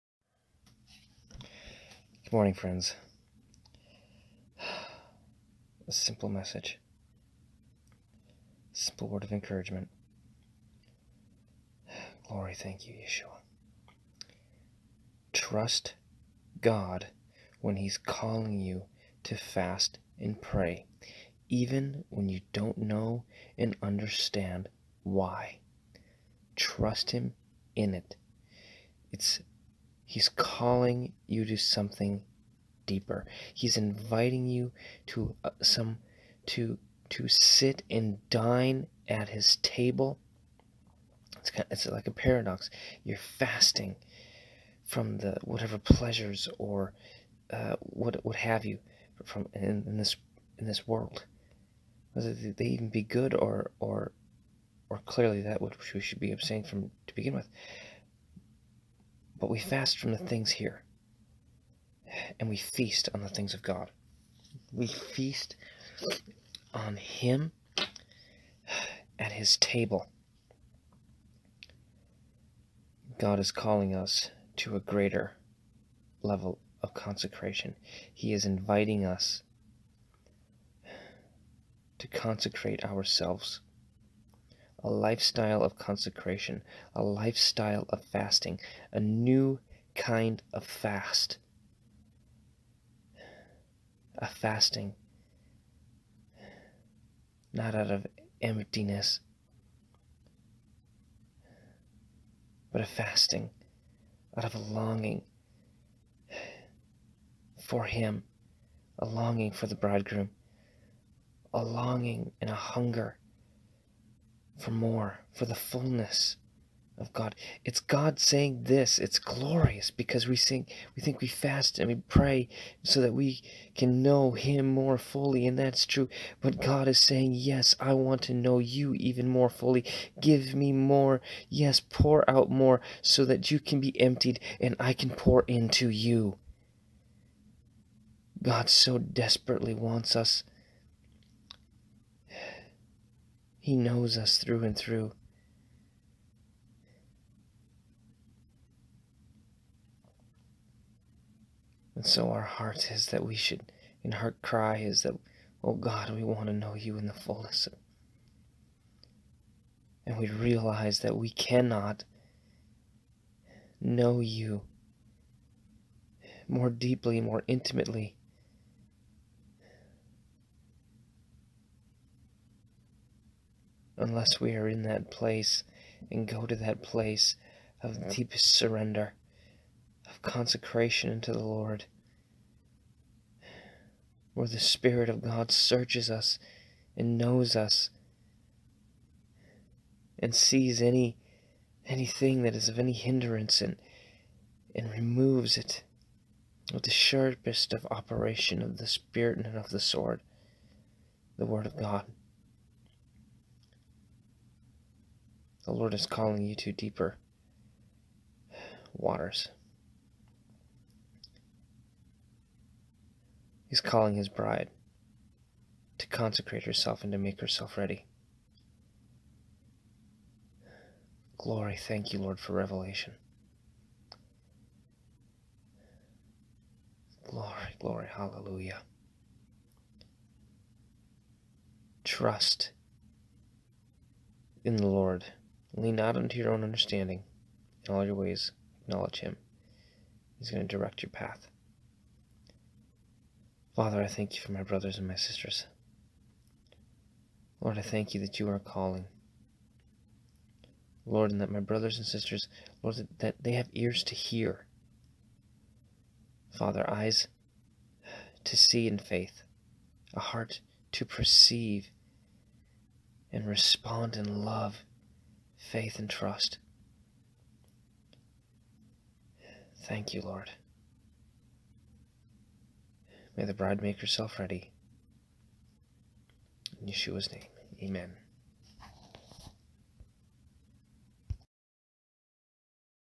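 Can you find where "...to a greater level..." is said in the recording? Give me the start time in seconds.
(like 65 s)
74 s.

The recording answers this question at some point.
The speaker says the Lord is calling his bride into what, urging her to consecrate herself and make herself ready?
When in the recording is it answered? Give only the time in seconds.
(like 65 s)
206 s.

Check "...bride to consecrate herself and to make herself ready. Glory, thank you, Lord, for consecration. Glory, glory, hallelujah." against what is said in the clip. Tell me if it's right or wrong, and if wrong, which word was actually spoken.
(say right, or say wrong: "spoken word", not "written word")
wrong: "revelation", not "consecration".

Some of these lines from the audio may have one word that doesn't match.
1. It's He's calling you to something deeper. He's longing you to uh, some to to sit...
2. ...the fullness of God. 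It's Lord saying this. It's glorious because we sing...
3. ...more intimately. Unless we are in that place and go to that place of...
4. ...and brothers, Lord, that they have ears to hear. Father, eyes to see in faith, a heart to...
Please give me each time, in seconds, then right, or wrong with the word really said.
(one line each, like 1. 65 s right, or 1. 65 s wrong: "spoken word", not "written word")
1. 29 s wrong: "inviting", not "longing"
2. 115 s wrong: "God", not "Lord"
3. 167 s right
4. 251 s wrong: "sisters", not "brothers".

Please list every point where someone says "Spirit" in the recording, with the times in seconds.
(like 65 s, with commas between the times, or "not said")
184 s, 198 s.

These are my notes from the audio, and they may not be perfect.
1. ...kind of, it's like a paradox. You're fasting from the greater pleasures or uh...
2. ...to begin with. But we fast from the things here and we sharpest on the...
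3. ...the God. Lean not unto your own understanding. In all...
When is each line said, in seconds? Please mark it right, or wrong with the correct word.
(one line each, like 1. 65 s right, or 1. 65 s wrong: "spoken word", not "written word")
1. 41 s wrong: "whatever", not "greater"
2. 57 s wrong: "feast", not "sharpest"
3. 234 s wrong: "Lord", not "God".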